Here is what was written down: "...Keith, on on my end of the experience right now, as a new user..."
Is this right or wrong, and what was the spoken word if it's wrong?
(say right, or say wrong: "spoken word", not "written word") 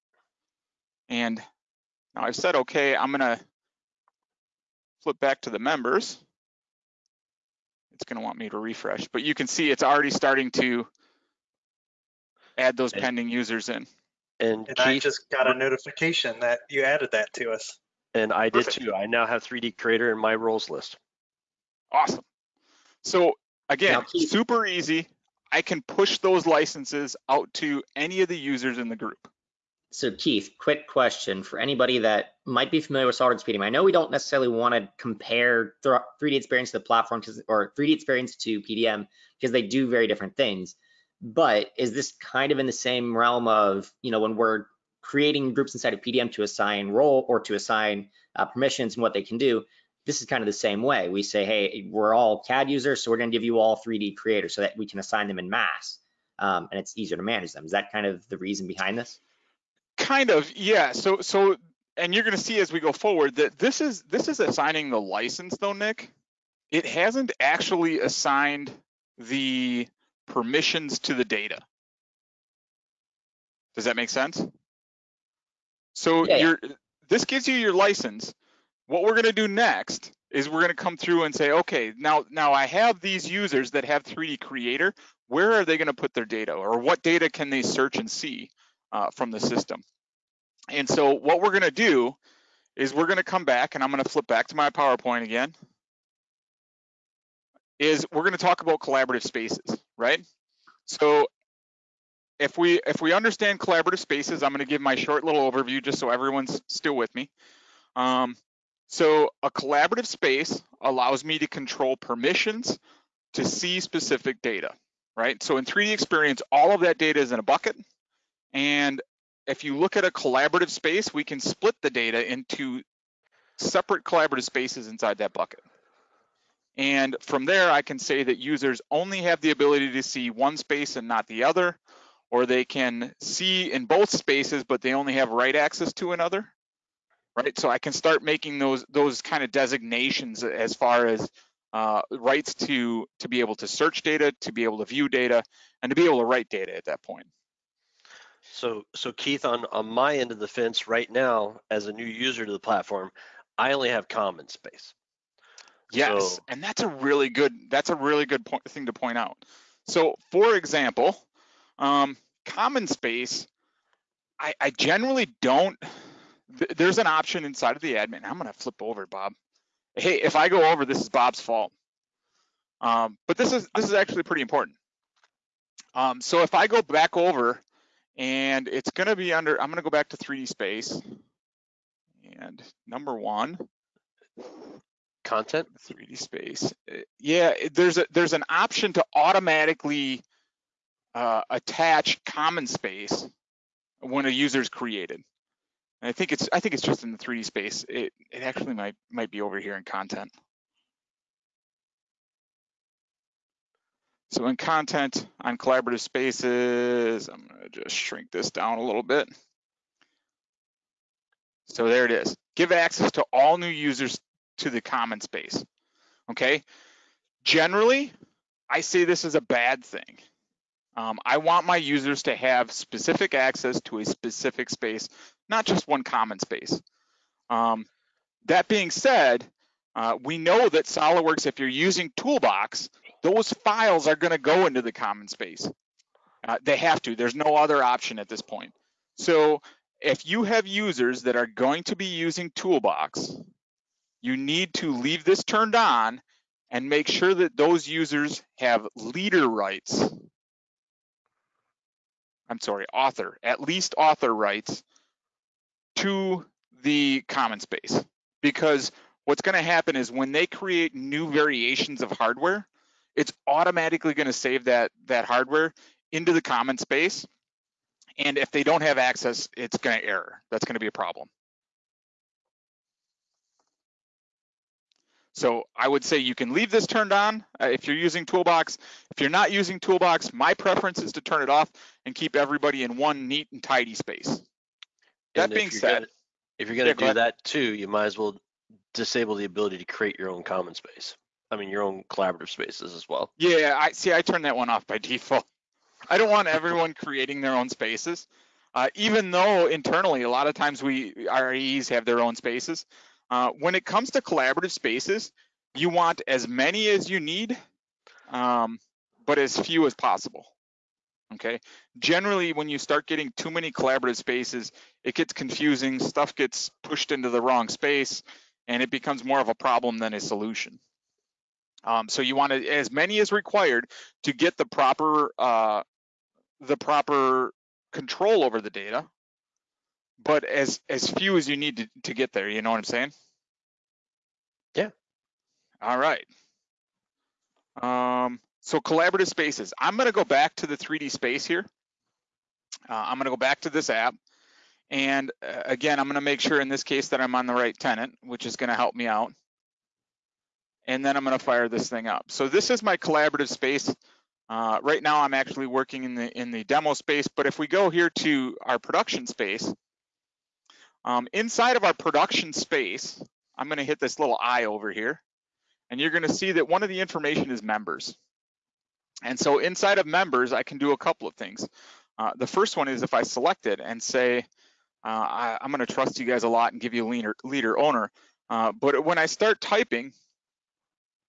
wrong: "fence", not "experience".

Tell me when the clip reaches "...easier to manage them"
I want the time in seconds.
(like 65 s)
56 s.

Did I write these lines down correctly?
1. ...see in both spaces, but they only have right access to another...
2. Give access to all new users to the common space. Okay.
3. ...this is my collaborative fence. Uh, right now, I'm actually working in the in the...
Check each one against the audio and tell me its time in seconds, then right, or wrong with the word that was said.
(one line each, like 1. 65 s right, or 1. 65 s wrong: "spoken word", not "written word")
1. 133 s right
2. 212 s right
3. 352 s wrong: "space", not "fence".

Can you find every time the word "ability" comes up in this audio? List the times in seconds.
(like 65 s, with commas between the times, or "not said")
129 s, 289 s.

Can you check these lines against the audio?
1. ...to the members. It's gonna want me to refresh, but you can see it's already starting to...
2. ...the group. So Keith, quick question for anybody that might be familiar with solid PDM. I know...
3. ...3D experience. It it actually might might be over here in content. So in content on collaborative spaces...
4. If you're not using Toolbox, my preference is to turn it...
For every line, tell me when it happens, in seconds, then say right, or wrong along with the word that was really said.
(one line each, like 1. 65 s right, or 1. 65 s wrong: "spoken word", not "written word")
1. 5 s right
2. 28 s right
3. 197 s wrong: "space", not "experience"
4. 279 s right.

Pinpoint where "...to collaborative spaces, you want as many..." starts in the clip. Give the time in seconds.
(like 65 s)
304 s.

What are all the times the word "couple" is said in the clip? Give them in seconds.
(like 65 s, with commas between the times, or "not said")
370 s.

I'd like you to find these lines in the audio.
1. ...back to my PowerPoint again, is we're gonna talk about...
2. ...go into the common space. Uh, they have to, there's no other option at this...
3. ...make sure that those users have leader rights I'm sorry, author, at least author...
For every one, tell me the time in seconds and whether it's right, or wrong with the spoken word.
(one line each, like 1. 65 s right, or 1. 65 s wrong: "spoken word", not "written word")
1. 94 s right
2. 234 s right
3. 246 s right.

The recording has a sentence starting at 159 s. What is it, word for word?
So, for example, um, common space, I, I generally don't, there's an option inside of the admin.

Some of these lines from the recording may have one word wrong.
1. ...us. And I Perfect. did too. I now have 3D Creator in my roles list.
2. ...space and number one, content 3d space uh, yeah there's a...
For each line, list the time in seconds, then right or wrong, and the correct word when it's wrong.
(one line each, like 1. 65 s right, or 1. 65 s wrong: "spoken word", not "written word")
1. 17 s right
2. 180 s right.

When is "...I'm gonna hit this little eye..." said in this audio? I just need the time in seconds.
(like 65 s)
363 s.